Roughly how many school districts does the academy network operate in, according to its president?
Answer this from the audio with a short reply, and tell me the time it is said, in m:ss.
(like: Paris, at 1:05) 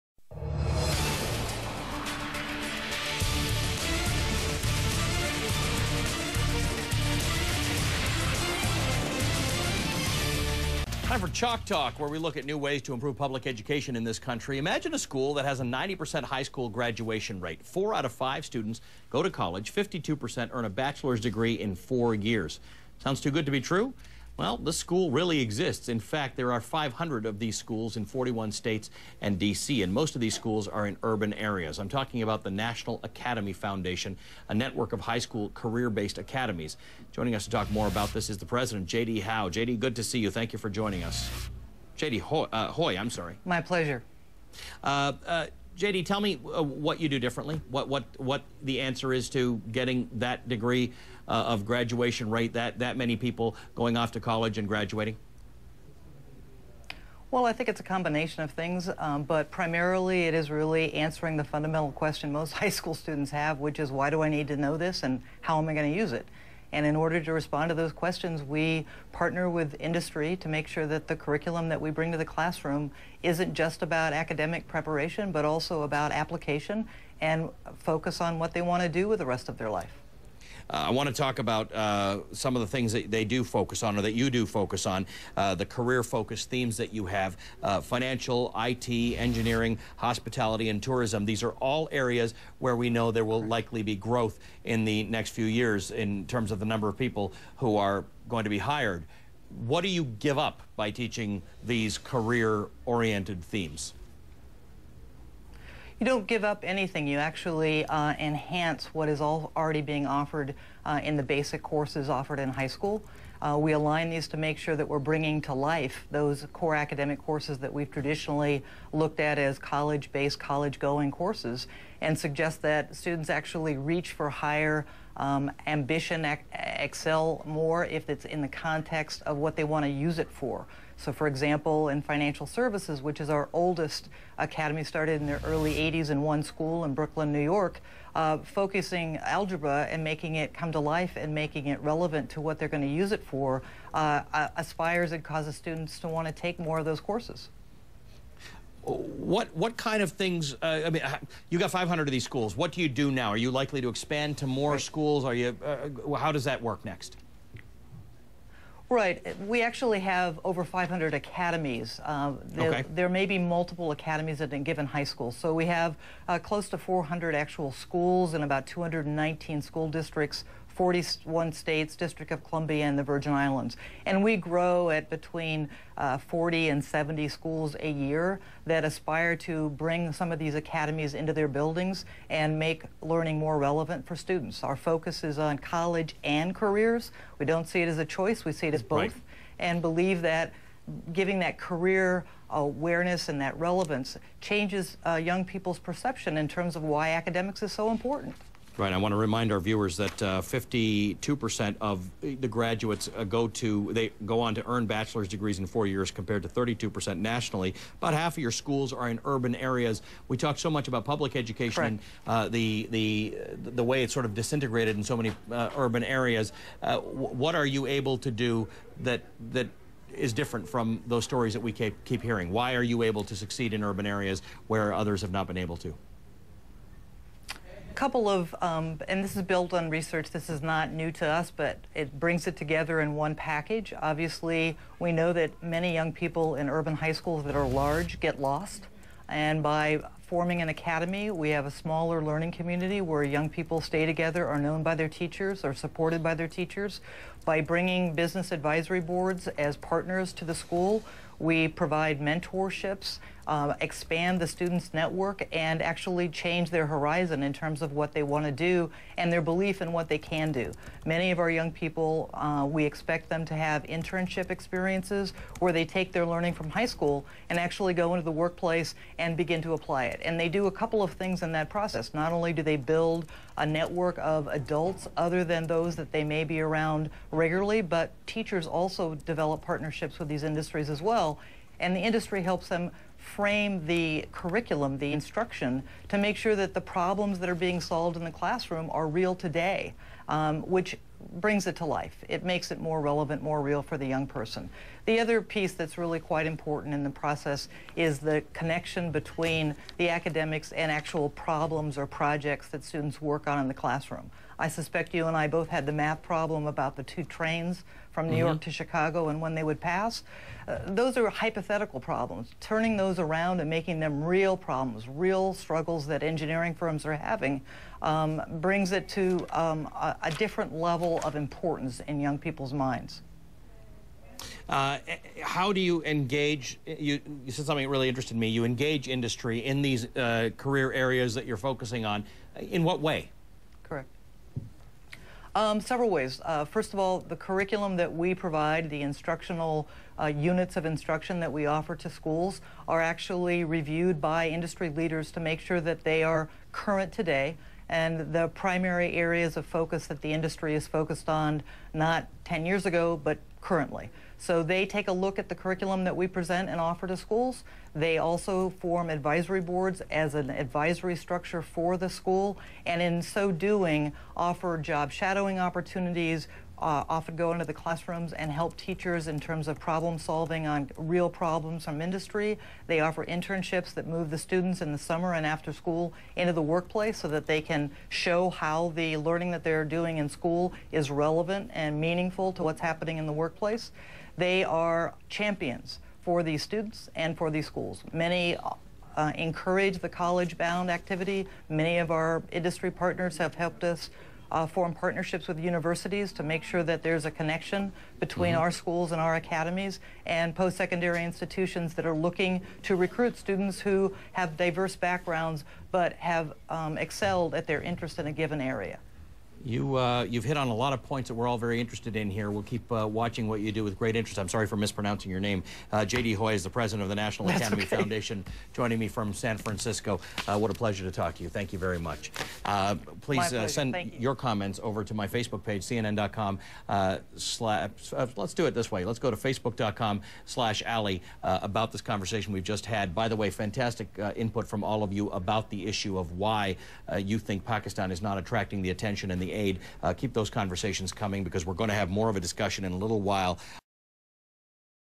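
219, at 2:48.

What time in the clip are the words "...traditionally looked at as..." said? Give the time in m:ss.
1:57.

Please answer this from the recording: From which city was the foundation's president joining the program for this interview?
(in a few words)
San Francisco.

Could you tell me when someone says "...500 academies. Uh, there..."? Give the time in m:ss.
2:40.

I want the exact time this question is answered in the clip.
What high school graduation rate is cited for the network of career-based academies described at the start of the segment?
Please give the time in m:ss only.
0:15.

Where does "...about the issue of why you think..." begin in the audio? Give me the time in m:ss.
7:15.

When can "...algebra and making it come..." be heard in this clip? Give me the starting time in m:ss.
2:19.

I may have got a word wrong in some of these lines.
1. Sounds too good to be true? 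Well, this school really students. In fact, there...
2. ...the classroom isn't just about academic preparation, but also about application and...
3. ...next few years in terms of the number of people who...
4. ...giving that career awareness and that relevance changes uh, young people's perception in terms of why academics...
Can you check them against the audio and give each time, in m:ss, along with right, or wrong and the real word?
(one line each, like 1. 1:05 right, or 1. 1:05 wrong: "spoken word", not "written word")
1. 0:23 wrong: "exists", not "students"
2. 1:12 right
3. 1:35 right
4. 3:11 right.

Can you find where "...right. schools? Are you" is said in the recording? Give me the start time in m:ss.
2:34.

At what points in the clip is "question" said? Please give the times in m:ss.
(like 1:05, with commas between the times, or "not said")
1:01, 1:07.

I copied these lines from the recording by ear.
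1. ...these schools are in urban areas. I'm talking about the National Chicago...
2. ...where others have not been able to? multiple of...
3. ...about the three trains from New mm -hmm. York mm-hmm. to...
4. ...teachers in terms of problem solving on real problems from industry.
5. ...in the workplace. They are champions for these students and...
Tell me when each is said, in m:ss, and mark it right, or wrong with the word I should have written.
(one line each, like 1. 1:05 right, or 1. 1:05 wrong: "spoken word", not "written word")
1. 0:30 wrong: "Academy", not "Chicago"
2. 3:44 wrong: "couple", not "multiple"
3. 5:06 wrong: "two", not "three"
4. 6:08 right
5. 6:23 right.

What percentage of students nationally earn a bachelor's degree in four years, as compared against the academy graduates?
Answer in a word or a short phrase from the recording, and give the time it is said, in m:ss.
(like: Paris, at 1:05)
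32%, at 3:26.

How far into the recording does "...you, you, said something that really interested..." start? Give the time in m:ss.
5:27.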